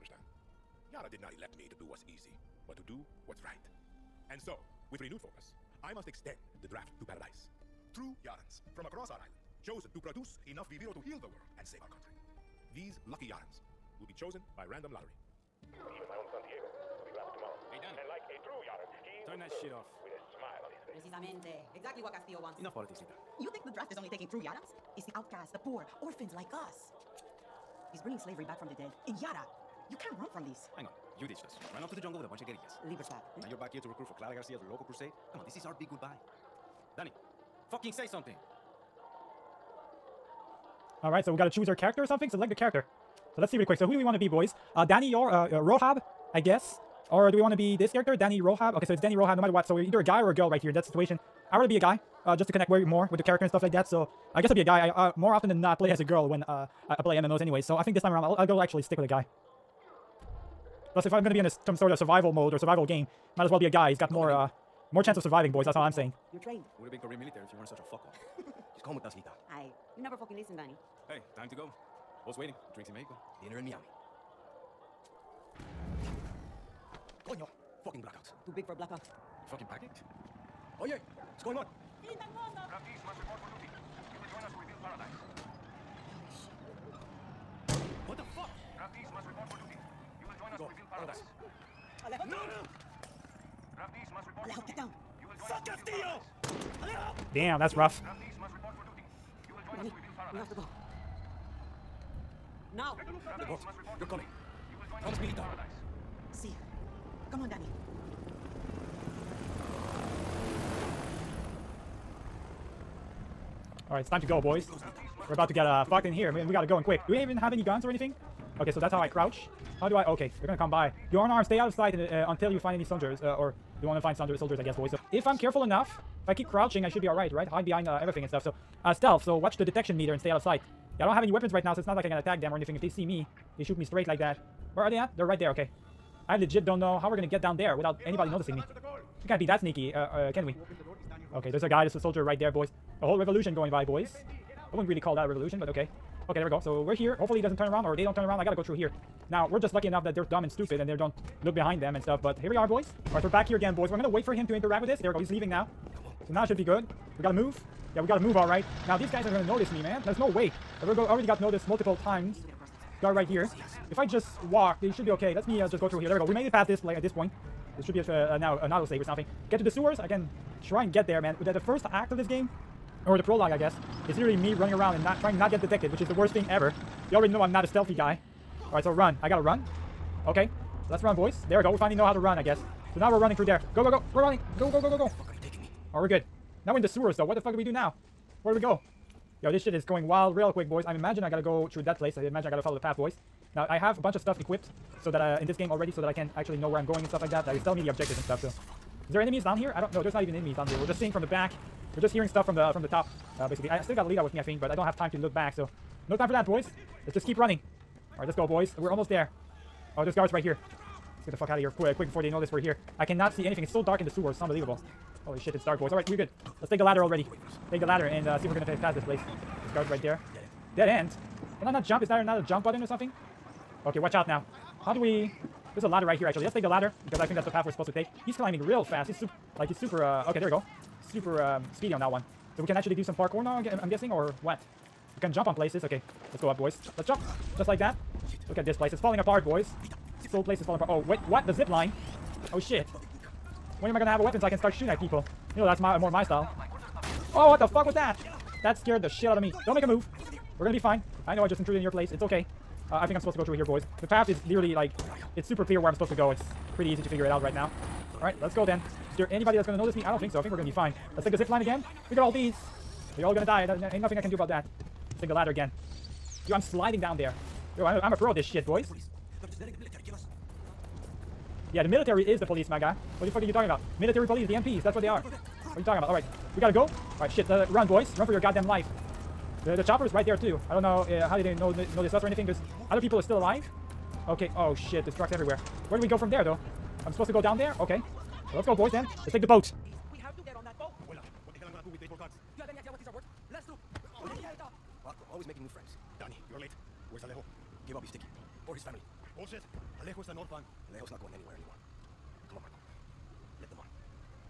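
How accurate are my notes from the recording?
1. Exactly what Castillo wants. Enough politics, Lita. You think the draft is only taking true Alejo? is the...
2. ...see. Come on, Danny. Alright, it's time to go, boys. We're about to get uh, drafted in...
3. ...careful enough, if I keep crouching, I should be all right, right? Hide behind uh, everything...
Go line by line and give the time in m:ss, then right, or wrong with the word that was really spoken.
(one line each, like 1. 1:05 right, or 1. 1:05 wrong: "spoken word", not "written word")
1. 0:21 wrong: "Yarans", not "Alejo"
2. 1:46 wrong: "fucked", not "drafted"
3. 2:05 right.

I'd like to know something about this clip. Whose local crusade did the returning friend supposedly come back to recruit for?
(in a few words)
Clara Garcia.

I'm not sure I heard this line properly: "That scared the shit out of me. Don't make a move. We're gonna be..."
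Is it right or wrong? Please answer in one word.
right.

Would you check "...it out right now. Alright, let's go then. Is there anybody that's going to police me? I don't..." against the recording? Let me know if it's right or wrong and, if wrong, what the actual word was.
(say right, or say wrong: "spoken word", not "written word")
wrong: "notice", not "police".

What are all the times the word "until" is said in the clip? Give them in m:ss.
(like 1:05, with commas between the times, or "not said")
2:02.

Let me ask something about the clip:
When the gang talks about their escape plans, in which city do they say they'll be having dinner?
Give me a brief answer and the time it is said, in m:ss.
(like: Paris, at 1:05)
Miami, at 1:13.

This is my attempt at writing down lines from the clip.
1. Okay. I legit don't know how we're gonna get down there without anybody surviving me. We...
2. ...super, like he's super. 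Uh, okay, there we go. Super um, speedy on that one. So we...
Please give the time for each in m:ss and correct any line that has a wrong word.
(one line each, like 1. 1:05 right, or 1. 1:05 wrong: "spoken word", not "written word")
1. 2:15 wrong: "noticing", not "surviving"
2. 3:49 right.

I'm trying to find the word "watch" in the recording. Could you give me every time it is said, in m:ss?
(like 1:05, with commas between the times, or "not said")
2:09, 3:43.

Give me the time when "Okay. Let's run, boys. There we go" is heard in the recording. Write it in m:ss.
3:00.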